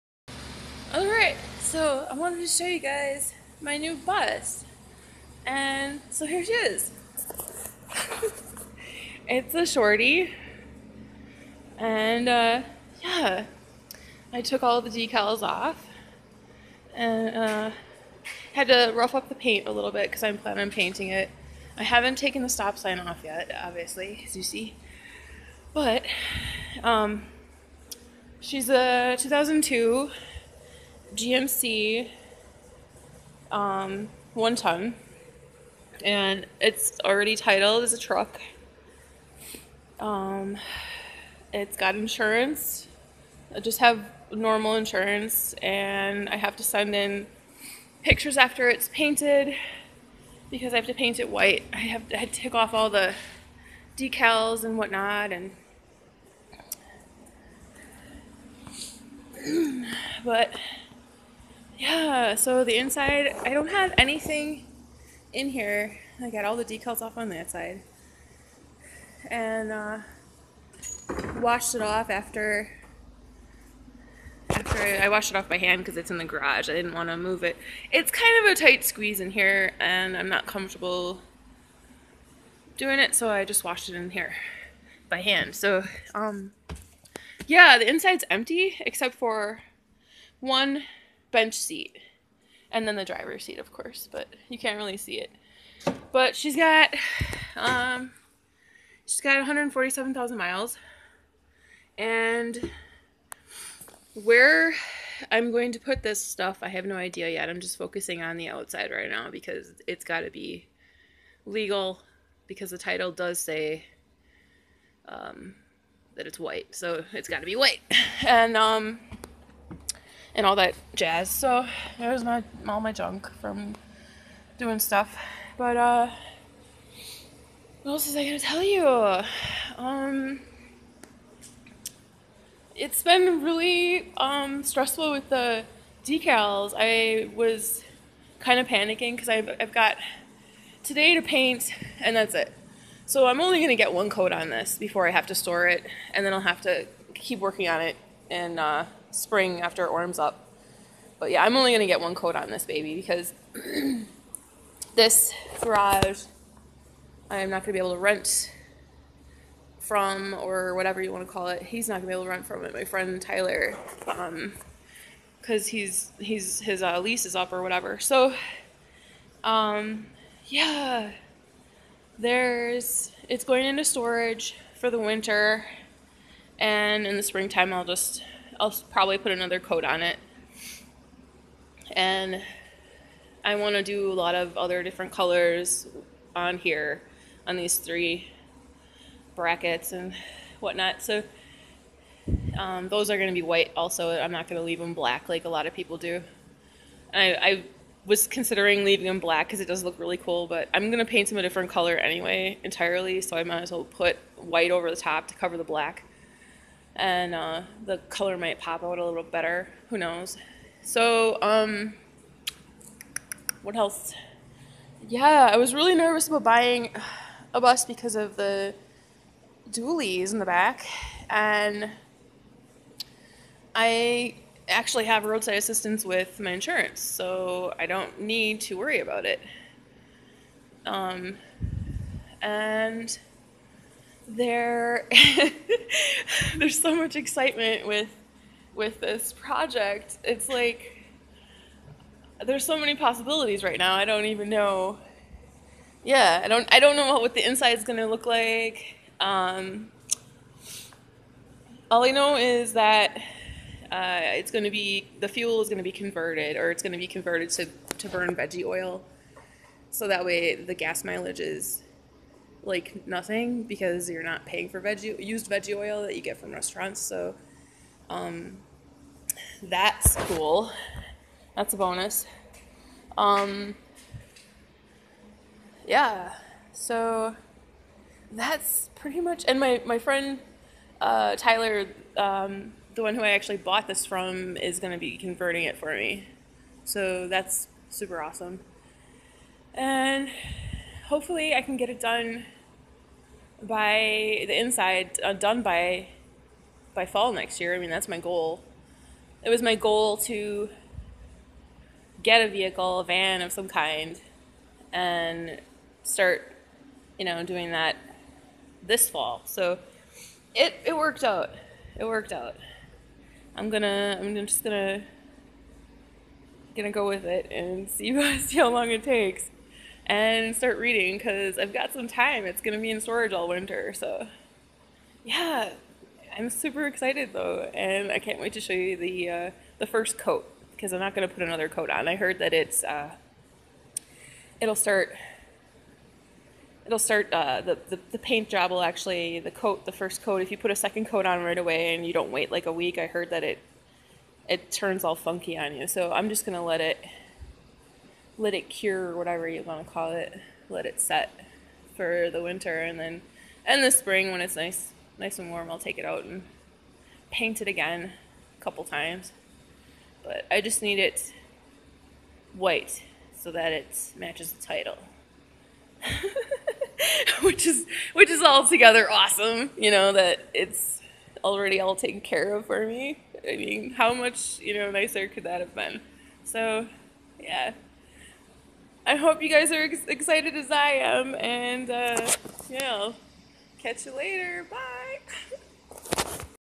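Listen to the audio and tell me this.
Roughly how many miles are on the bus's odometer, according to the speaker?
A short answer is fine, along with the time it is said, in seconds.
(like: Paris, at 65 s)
147,000, at 99 s.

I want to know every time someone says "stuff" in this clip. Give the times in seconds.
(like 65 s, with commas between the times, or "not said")
106 s, 124 s.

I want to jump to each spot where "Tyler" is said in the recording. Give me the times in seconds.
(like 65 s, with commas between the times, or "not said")
163 s, 281 s.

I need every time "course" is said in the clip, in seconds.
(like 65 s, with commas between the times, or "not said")
93 s.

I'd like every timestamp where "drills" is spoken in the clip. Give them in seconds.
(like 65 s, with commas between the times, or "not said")
not said.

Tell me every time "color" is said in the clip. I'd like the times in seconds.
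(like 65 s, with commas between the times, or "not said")
185 s, 201 s, 208 s.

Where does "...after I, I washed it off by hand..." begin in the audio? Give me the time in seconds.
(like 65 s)
74 s.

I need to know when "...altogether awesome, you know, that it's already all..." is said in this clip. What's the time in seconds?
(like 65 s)
368 s.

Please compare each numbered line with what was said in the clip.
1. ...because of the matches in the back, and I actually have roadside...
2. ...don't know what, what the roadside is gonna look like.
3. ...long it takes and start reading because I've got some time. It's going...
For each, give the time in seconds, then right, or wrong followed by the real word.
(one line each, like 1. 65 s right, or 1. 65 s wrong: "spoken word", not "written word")
1. 217 s wrong: "dualies", not "matches"
2. 246 s wrong: "inside", not "roadside"
3. 318 s right.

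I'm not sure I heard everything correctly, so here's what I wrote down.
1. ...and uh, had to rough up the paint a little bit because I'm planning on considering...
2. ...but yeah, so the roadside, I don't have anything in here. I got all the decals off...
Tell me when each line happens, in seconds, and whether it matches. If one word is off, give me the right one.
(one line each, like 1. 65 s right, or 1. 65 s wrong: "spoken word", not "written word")
1. 16 s wrong: "painting", not "considering"
2. 60 s wrong: "inside", not "roadside".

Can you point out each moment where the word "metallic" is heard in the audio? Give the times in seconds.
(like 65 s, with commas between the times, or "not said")
not said.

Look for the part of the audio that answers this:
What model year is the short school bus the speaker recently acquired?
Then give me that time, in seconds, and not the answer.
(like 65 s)
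29 s.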